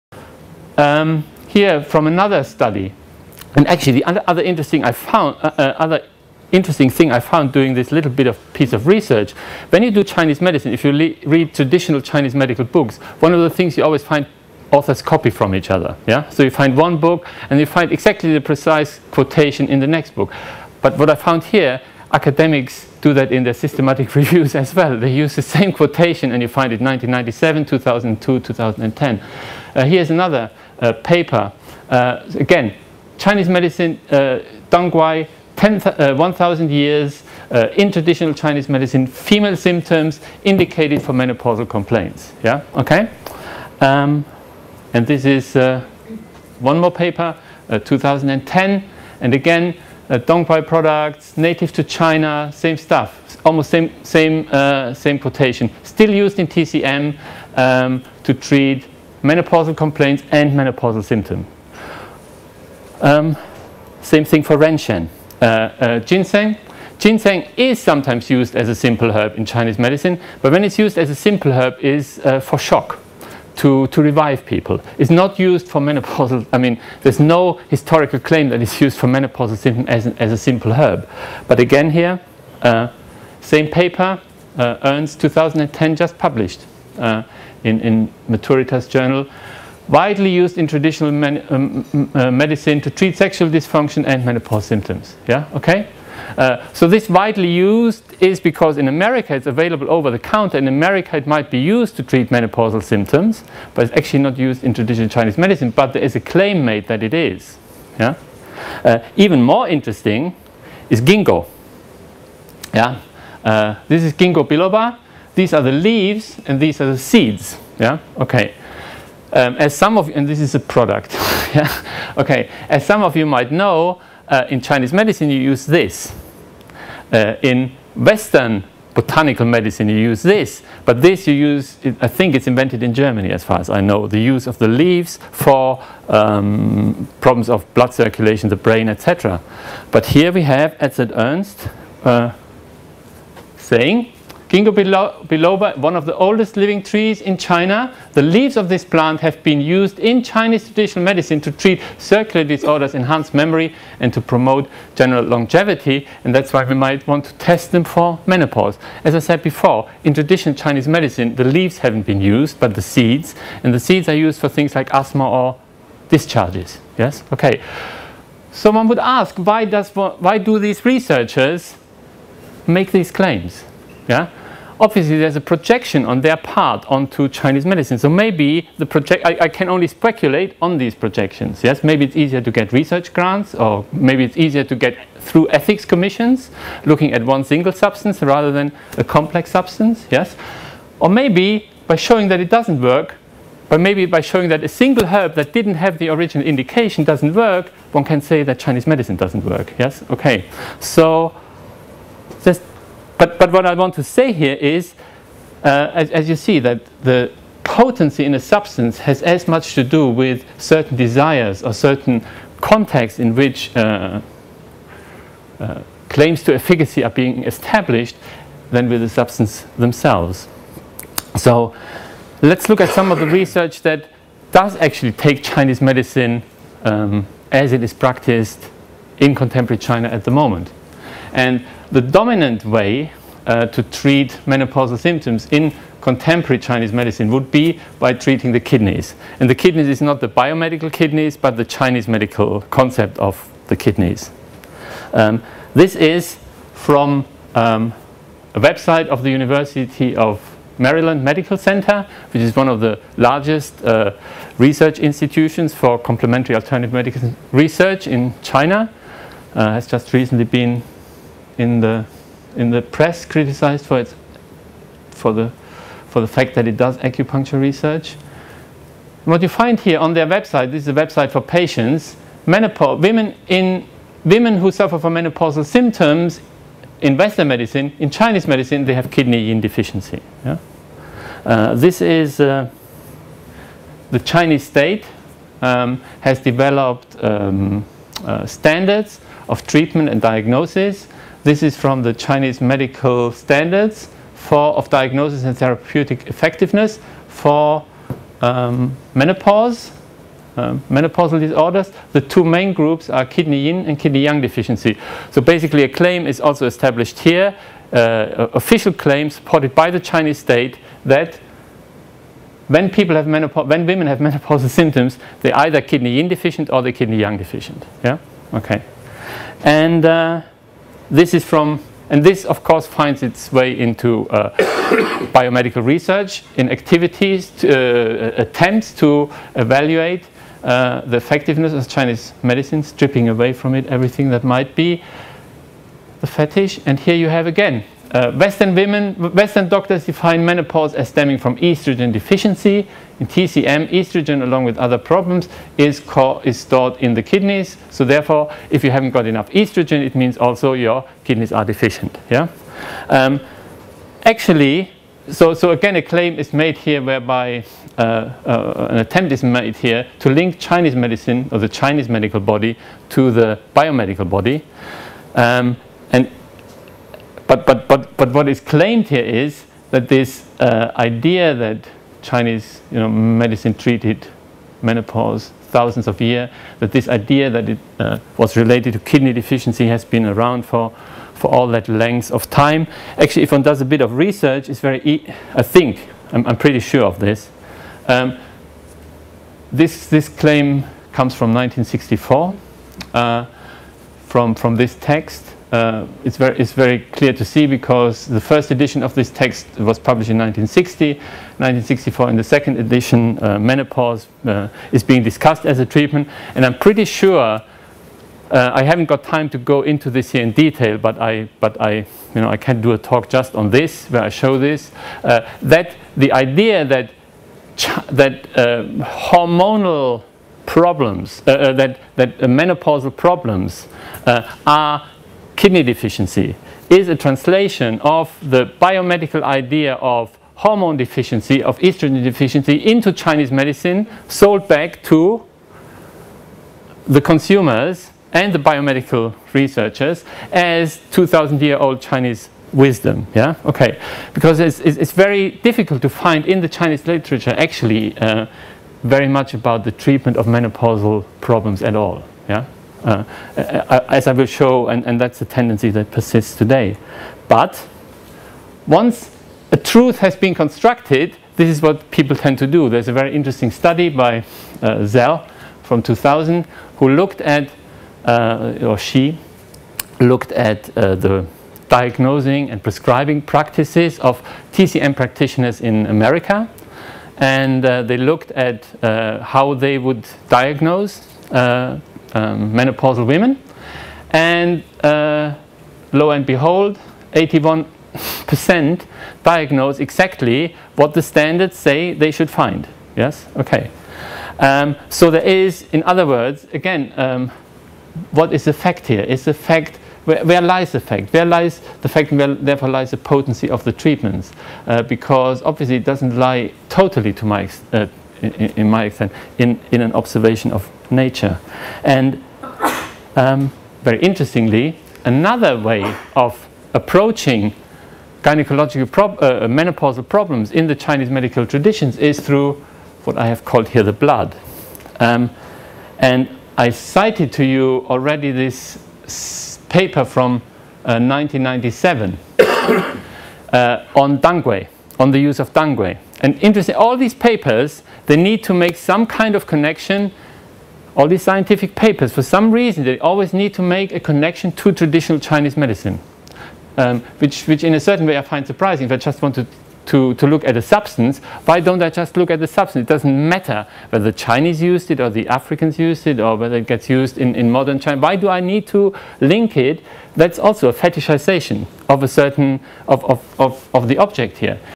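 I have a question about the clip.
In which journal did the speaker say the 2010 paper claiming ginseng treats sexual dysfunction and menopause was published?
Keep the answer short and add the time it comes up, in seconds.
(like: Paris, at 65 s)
Maturitas, at 88 s.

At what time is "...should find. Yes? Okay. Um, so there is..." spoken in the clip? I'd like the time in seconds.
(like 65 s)
492 s.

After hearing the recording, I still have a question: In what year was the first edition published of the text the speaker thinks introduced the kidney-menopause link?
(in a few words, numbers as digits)
1960.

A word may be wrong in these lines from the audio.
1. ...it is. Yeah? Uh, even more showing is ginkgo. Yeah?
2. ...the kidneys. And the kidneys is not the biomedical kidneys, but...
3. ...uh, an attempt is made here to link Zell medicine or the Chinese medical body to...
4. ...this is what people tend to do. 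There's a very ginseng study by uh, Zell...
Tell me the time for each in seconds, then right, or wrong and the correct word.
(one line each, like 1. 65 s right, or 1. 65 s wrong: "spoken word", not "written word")
1. 107 s wrong: "interesting", not "showing"
2. 238 s right
3. 358 s wrong: "Chinese", not "Zell"
4. 461 s wrong: "interesting", not "ginseng".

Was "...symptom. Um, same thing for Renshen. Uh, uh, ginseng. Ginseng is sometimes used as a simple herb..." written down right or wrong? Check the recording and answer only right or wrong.
right.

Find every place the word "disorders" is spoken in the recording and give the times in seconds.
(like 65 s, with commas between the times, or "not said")
152 s, 301 s.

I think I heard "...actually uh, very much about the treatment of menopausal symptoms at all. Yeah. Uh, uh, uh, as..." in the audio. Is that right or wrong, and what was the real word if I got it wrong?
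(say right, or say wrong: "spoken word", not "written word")
wrong: "problems", not "symptoms".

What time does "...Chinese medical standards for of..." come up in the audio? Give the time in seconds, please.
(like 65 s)
292 s.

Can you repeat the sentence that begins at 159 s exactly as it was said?
As I said before, in traditional Chinese medicine, the leaves haven't been used, but the seeds.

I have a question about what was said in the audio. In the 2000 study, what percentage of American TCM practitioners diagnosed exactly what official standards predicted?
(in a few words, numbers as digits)
81%.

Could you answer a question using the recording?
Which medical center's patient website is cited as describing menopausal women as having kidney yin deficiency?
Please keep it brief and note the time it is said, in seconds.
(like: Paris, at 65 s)
University of Maryland Medical Center, at 249 s.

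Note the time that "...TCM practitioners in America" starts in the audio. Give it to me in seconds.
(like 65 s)
474 s.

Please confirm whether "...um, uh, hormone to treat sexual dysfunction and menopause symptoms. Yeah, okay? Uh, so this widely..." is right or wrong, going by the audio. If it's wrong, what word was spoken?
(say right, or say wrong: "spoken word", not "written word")
wrong: "medicine", not "hormone".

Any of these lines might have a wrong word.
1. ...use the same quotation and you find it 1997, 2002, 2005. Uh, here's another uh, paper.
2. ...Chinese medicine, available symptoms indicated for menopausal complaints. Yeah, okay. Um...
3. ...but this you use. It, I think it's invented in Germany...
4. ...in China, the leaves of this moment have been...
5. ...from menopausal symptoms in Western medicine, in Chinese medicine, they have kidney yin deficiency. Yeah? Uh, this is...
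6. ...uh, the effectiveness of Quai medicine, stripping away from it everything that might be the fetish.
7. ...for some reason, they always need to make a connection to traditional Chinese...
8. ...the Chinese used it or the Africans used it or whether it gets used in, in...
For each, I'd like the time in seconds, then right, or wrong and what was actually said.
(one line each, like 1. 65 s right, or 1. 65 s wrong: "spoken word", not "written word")
1. 25 s wrong: "2010", not "2005"
2. 38 s wrong: "female", not "available"
3. 130 s right
4. 147 s wrong: "plant", not "moment"
5. 274 s right
6. 330 s wrong: "Chinese", not "Quai"
7. 542 s right
8. 554 s right.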